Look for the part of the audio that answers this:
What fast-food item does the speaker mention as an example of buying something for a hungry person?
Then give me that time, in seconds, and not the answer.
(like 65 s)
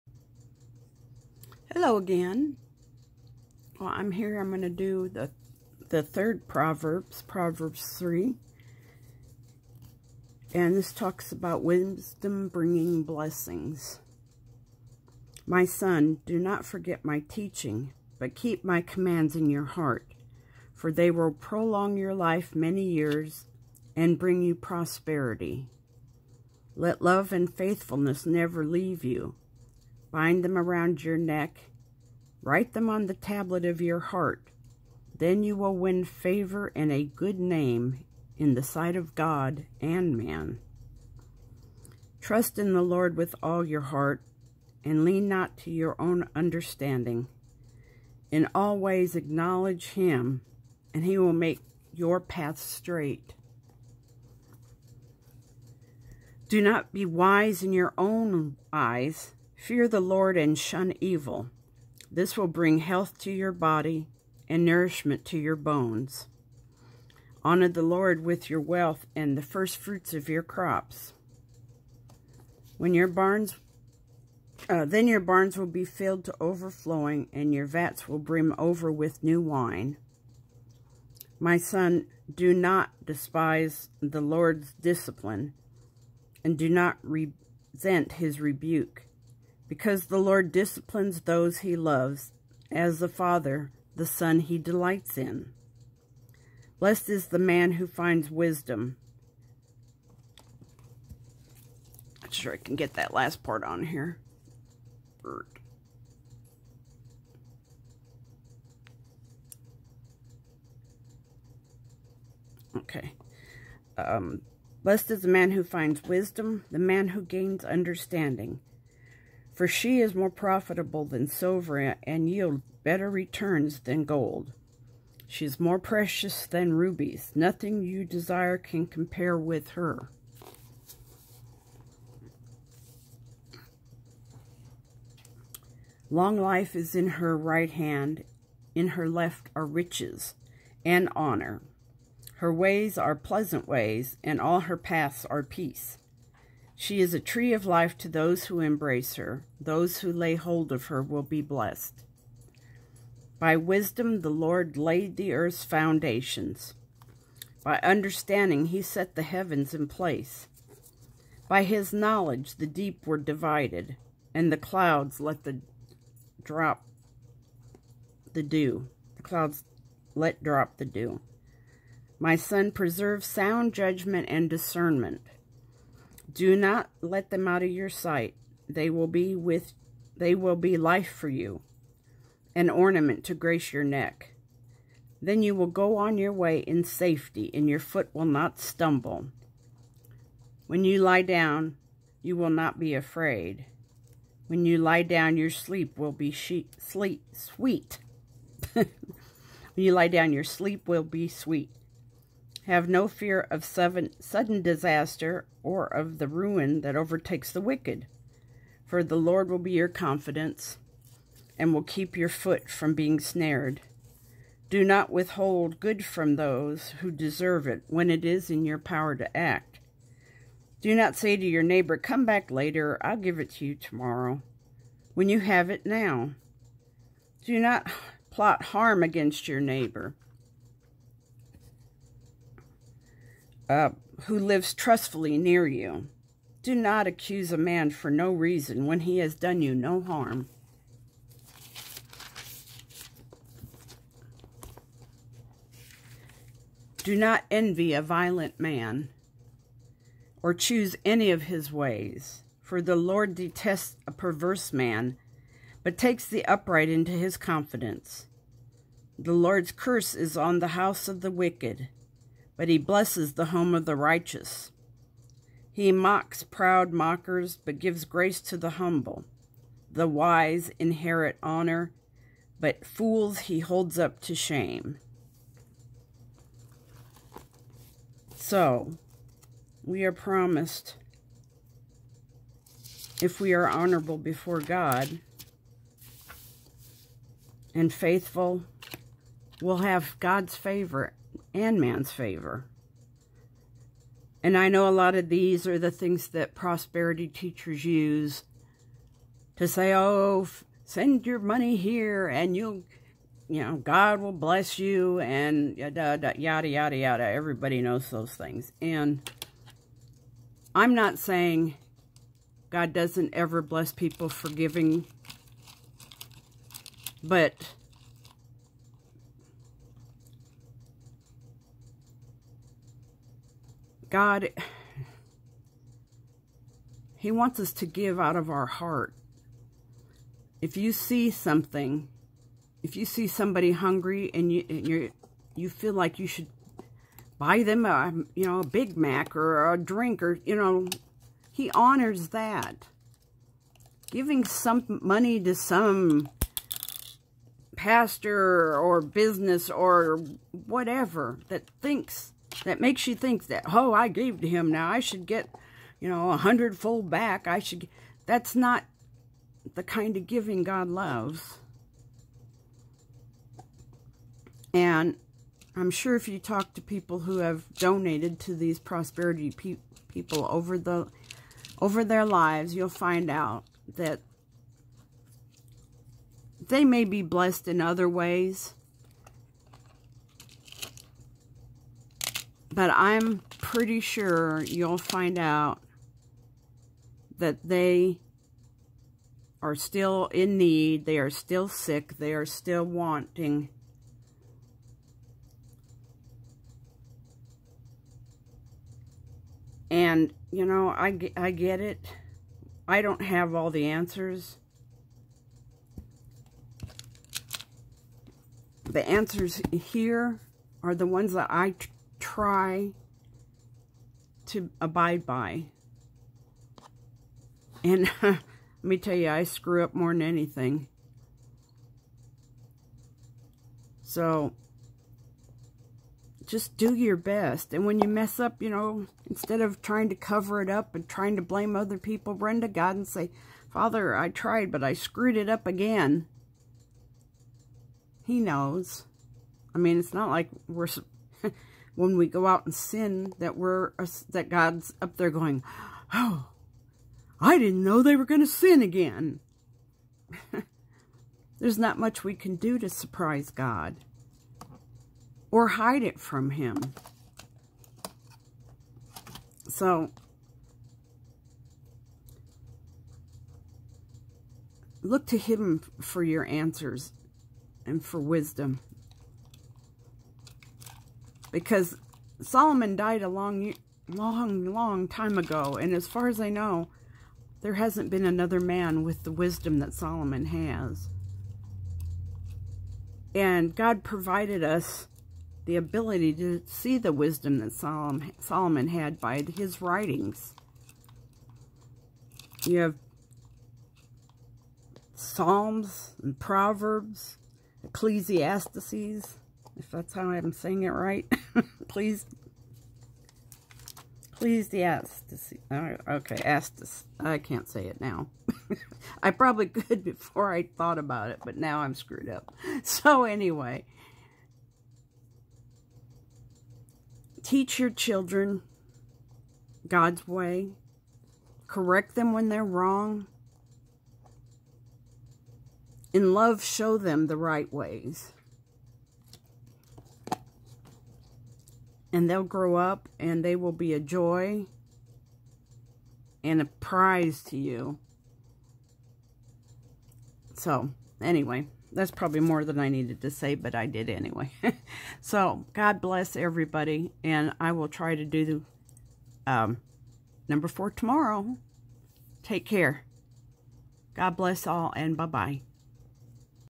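338 s.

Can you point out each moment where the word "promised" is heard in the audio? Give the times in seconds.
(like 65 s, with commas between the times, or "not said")
280 s.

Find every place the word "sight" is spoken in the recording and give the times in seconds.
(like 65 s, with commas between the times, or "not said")
38 s, 177 s.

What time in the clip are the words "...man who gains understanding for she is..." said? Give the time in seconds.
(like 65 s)
116 s.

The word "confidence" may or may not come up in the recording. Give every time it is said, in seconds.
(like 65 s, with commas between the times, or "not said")
209 s, 257 s.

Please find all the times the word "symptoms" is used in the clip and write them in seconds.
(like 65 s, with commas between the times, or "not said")
not said.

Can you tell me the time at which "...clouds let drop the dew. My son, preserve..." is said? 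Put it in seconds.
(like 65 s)
169 s.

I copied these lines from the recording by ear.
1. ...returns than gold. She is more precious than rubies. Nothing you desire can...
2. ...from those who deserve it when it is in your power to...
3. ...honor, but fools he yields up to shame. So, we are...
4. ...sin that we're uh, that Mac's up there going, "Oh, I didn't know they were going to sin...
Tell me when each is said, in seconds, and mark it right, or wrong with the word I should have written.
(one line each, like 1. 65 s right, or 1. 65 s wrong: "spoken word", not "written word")
1. 123 s right
2. 216 s right
3. 271 s wrong: "holds", not "yields"
4. 442 s wrong: "God", not "Mac".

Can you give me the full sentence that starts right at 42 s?
Trust in the Lord with all your heart, and lean not to your own understanding.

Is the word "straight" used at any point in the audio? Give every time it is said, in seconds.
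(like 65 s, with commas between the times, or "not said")
52 s.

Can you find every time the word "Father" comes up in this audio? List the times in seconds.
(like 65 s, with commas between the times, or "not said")
93 s, 433 s.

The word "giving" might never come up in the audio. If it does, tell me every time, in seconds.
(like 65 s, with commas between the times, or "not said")
314 s, 344 s, 360 s.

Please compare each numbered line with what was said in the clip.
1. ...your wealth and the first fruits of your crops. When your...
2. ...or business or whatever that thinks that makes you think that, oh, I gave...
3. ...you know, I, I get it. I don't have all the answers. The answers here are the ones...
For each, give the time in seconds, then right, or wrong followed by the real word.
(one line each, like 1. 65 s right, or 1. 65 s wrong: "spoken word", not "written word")
1. 68 s right
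2. 348 s right
3. 400 s right.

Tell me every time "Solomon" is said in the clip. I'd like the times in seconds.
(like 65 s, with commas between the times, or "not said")
472 s, 479 s, 488 s.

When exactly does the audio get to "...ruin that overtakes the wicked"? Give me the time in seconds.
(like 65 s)
206 s.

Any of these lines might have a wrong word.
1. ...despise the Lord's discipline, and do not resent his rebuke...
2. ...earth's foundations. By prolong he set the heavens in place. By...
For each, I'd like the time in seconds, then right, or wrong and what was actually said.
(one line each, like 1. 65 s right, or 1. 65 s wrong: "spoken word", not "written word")
1. 83 s right
2. 155 s wrong: "understanding", not "prolong".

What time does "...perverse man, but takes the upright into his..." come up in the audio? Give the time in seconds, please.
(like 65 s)
254 s.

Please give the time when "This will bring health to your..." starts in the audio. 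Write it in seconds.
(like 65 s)
62 s.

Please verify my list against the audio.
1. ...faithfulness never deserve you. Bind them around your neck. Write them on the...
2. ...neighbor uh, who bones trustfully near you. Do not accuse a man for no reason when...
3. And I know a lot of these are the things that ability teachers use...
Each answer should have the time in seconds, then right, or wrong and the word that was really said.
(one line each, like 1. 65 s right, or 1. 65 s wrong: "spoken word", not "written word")
1. 27 s wrong: "leave", not "deserve"
2. 229 s wrong: "lives", not "bones"
3. 294 s wrong: "prosperity", not "ability".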